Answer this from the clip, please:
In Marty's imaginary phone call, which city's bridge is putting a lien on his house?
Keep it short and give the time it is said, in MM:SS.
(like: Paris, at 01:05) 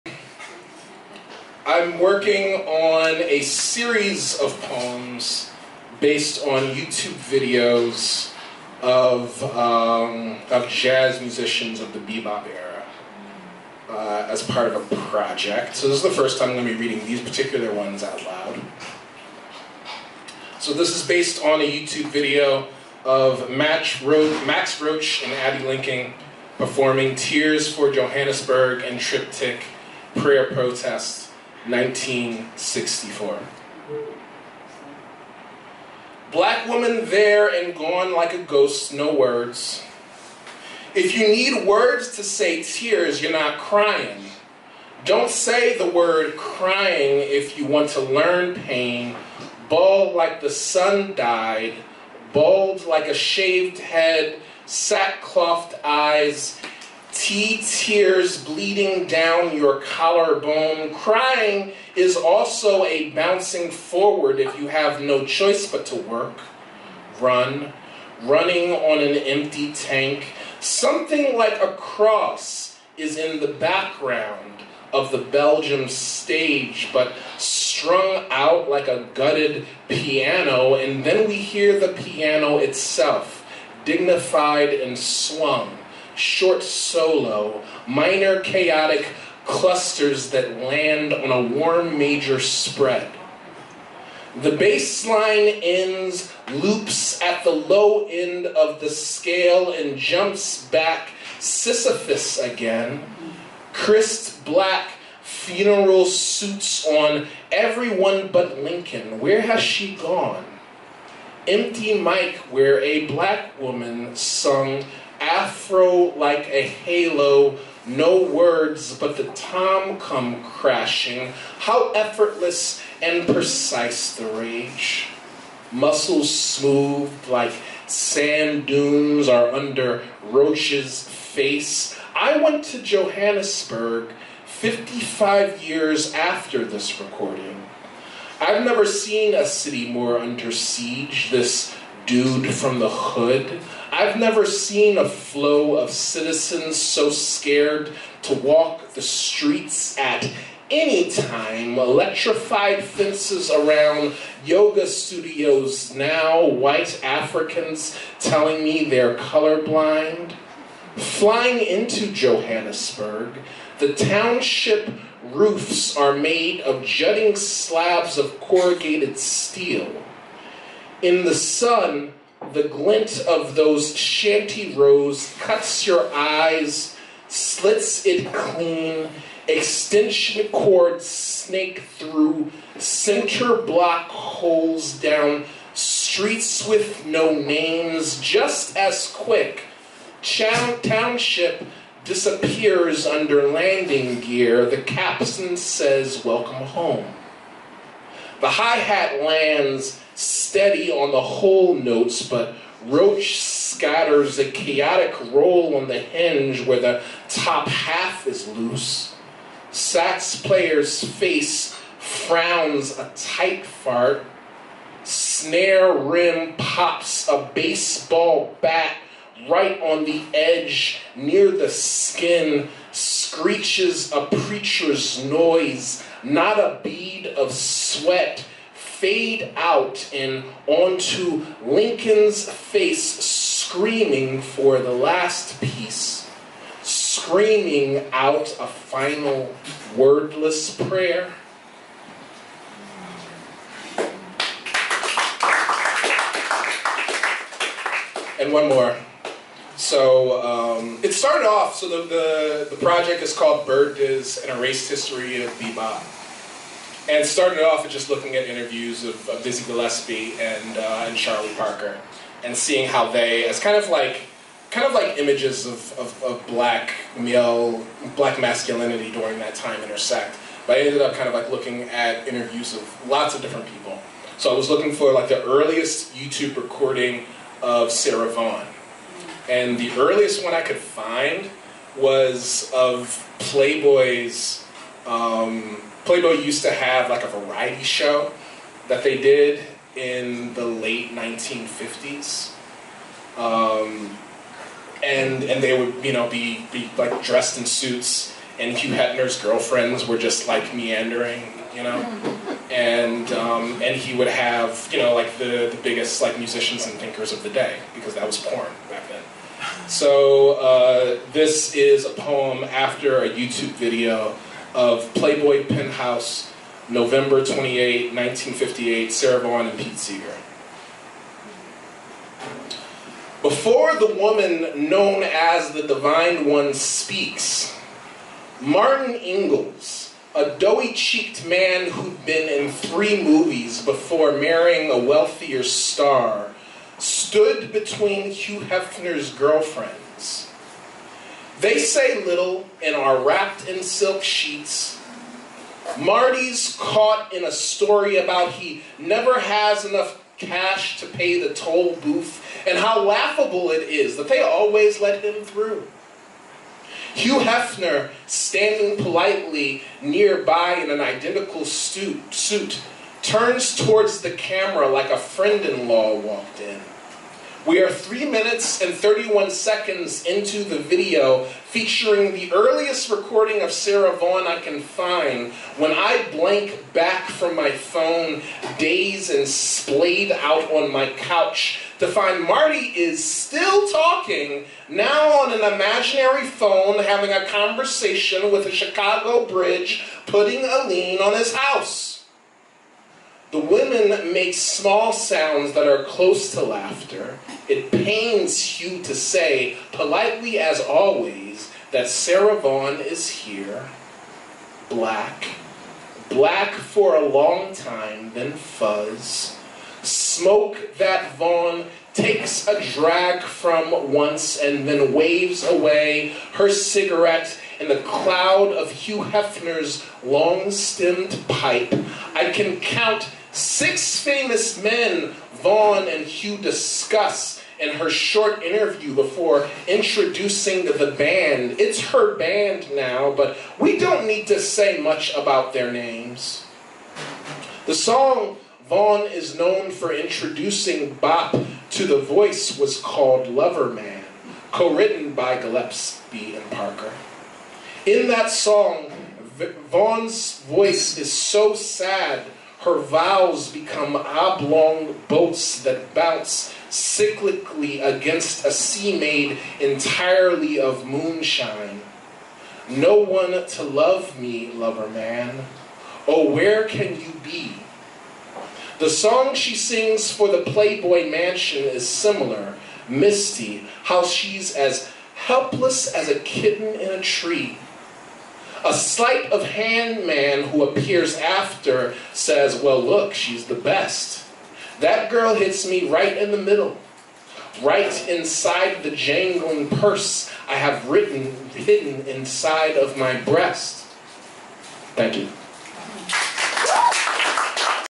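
Chicago, at 06:28.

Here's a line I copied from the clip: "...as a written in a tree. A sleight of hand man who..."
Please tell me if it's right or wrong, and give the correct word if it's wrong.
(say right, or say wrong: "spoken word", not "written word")
wrong: "kitten", not "written".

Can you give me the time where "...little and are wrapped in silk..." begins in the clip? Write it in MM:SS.
05:42.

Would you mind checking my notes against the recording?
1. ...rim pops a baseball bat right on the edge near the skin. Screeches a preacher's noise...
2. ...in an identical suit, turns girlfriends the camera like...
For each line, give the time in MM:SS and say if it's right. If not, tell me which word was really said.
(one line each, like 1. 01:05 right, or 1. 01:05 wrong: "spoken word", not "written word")
1. 03:35 right
2. 06:00 wrong: "towards", not "girlfriends".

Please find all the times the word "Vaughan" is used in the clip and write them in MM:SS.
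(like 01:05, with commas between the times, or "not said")
04:38, 05:19, 06:14, 06:42, 06:51, 07:05, 07:18, 07:29.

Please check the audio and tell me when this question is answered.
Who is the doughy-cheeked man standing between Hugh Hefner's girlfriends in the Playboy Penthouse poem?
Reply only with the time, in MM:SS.
05:28.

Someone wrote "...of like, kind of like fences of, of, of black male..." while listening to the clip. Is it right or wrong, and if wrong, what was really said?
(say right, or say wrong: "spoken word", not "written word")
wrong: "images", not "fences".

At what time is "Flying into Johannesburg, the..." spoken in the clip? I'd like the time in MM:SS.
02:40.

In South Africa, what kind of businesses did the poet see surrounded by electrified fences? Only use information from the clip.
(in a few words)
yoga studios.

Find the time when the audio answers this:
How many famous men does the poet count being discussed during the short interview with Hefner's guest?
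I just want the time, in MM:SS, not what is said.
07:03.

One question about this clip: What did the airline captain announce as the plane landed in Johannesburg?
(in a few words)
Welcome home.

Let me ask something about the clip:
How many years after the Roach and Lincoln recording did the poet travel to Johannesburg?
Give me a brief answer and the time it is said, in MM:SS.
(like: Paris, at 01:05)
55, at 02:14.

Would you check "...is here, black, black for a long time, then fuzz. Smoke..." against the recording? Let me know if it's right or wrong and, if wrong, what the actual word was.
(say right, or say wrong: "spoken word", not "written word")
right.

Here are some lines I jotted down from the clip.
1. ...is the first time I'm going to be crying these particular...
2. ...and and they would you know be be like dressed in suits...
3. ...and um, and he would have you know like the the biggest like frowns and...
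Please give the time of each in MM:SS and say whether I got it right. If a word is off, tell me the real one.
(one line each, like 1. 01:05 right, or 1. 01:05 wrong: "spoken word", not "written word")
1. 00:15 wrong: "reading", not "crying"
2. 04:55 right
3. 05:02 wrong: "musicians", not "frowns".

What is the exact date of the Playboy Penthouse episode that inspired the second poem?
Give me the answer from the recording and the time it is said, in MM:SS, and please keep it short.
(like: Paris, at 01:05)
November 28, 1958, at 05:16.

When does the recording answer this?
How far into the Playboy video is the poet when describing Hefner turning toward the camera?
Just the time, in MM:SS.
06:07.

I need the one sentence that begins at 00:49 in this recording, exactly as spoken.
Bald like the sun died, bald like a shaved head, sackcloth eyes, Tea tears bleeding down your collarbone.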